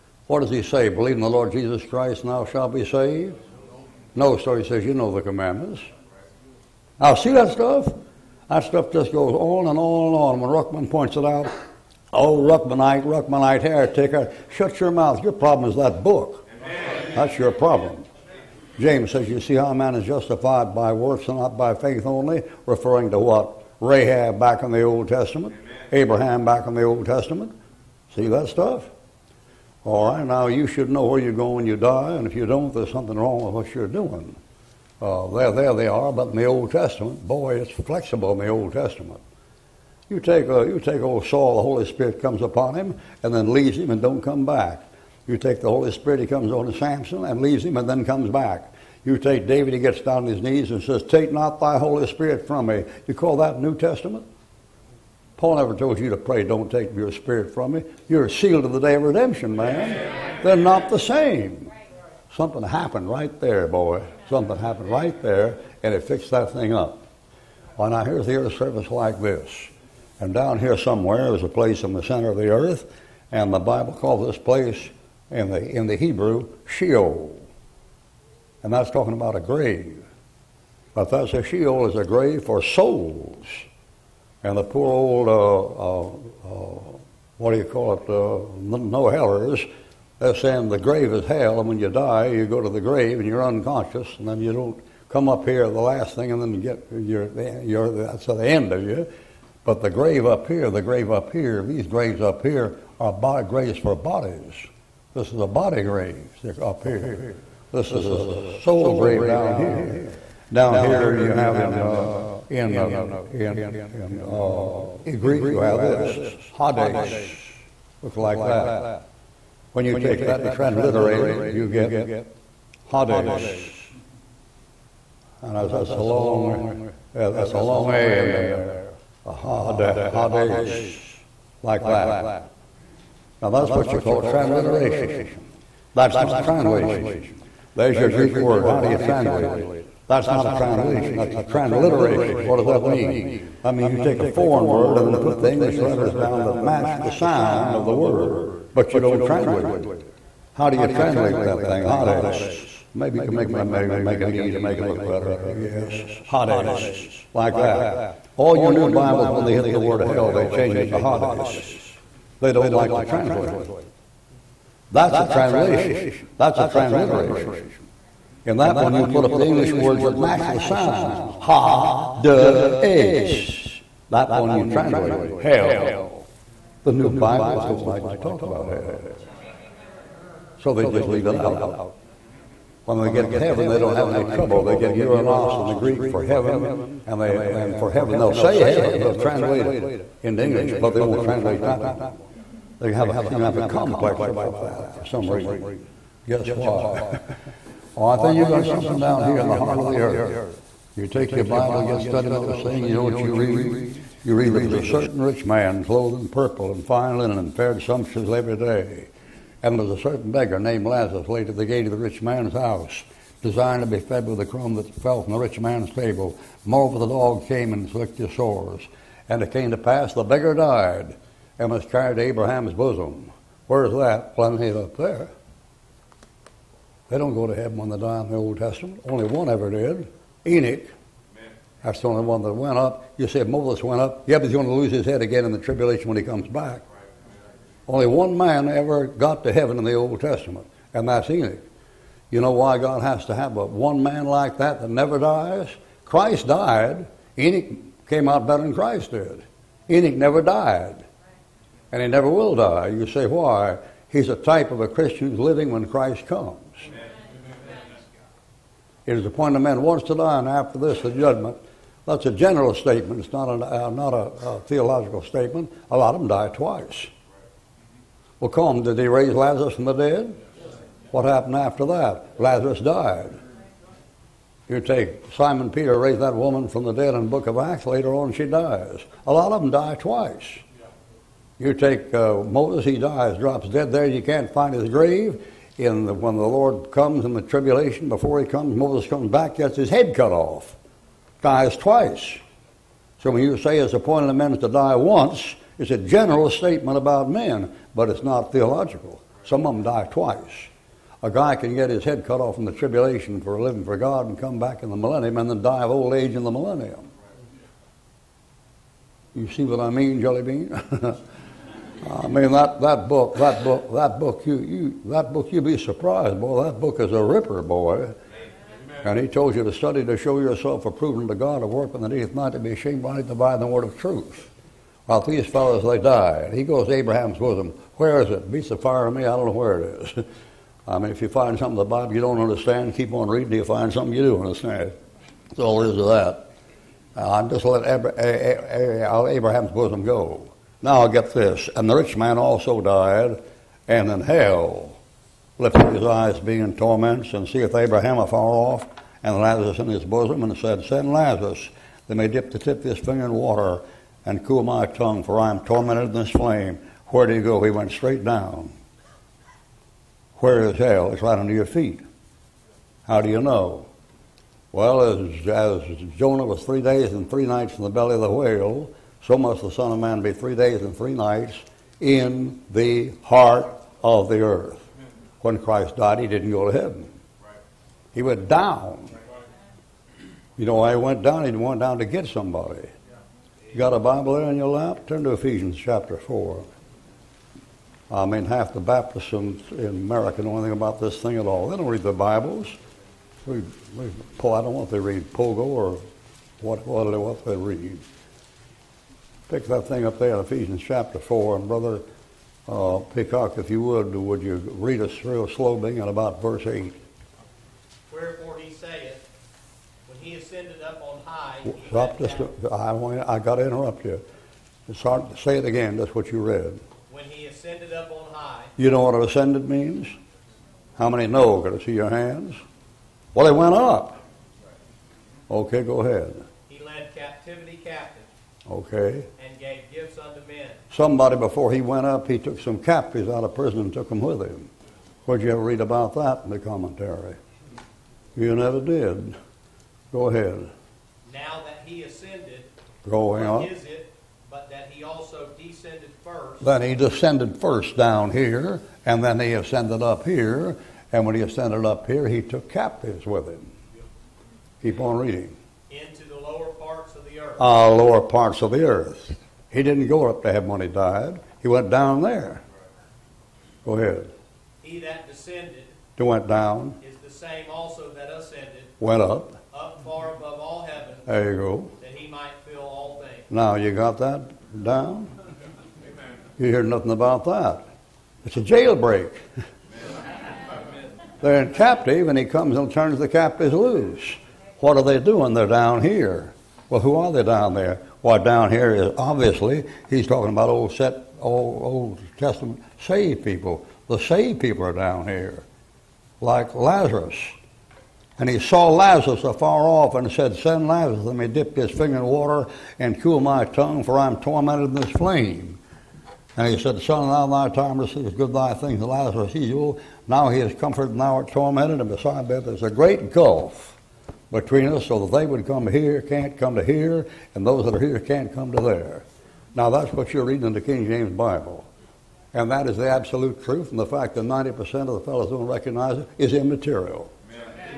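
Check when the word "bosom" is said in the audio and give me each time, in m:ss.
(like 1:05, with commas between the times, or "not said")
3:42, 5:27, 5:39, 5:50.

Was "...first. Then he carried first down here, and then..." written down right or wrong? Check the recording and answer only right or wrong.
wrong.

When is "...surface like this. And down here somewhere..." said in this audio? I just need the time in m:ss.
1:08.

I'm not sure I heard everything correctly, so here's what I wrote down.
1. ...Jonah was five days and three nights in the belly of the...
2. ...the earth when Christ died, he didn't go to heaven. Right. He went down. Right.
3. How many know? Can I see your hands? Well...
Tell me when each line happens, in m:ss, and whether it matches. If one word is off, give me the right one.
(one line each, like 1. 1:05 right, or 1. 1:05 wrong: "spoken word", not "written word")
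1. 6:06 wrong: "three", not "five"
2. 6:14 right
3. 7:00 right.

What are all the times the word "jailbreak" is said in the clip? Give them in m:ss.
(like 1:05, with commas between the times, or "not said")
7:58.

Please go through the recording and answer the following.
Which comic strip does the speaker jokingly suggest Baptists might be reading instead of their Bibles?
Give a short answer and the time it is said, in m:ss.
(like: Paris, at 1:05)
Pogo, at 6:35.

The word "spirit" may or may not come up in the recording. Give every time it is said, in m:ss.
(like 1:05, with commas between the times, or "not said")
0:41, 0:45, 0:52, 0:57.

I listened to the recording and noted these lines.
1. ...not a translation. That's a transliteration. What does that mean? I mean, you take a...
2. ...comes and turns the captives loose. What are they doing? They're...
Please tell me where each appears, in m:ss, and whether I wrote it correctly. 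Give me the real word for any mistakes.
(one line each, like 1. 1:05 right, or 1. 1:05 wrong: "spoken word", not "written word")
1. 2:20 right
2. 8:02 right.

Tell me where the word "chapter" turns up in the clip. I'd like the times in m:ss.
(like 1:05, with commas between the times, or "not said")
6:25, 6:40.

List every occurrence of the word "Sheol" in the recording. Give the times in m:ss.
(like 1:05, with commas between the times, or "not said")
1:16, 1:21.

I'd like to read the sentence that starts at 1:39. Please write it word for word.
But the grave up here, the grave up here, these graves up here are body, graves for bodies.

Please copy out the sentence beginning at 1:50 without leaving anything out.
Down here you have in uh, in uh, in in, uh, in Greek you have this Hades, look like that.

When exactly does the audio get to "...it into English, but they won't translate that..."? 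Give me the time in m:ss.
3:09.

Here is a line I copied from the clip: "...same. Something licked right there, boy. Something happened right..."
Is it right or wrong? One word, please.
wrong.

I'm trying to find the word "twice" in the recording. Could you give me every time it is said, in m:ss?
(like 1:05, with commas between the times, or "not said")
4:26, 4:39, 4:51, 5:00.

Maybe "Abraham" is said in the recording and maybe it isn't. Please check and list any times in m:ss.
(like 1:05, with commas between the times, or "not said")
0:25, 3:42, 5:26, 5:37, 5:47.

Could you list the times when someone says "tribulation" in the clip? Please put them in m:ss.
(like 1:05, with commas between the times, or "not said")
3:55, 4:47, 5:02.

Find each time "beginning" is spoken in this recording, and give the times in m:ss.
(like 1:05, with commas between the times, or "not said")
6:45.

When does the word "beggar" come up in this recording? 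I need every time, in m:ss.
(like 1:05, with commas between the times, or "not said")
3:30, 3:40.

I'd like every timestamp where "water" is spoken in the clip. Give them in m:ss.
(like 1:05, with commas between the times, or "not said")
5:53, 8:22.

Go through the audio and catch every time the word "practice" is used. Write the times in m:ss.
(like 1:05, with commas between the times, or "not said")
not said.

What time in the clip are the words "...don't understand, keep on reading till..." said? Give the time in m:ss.
5:32.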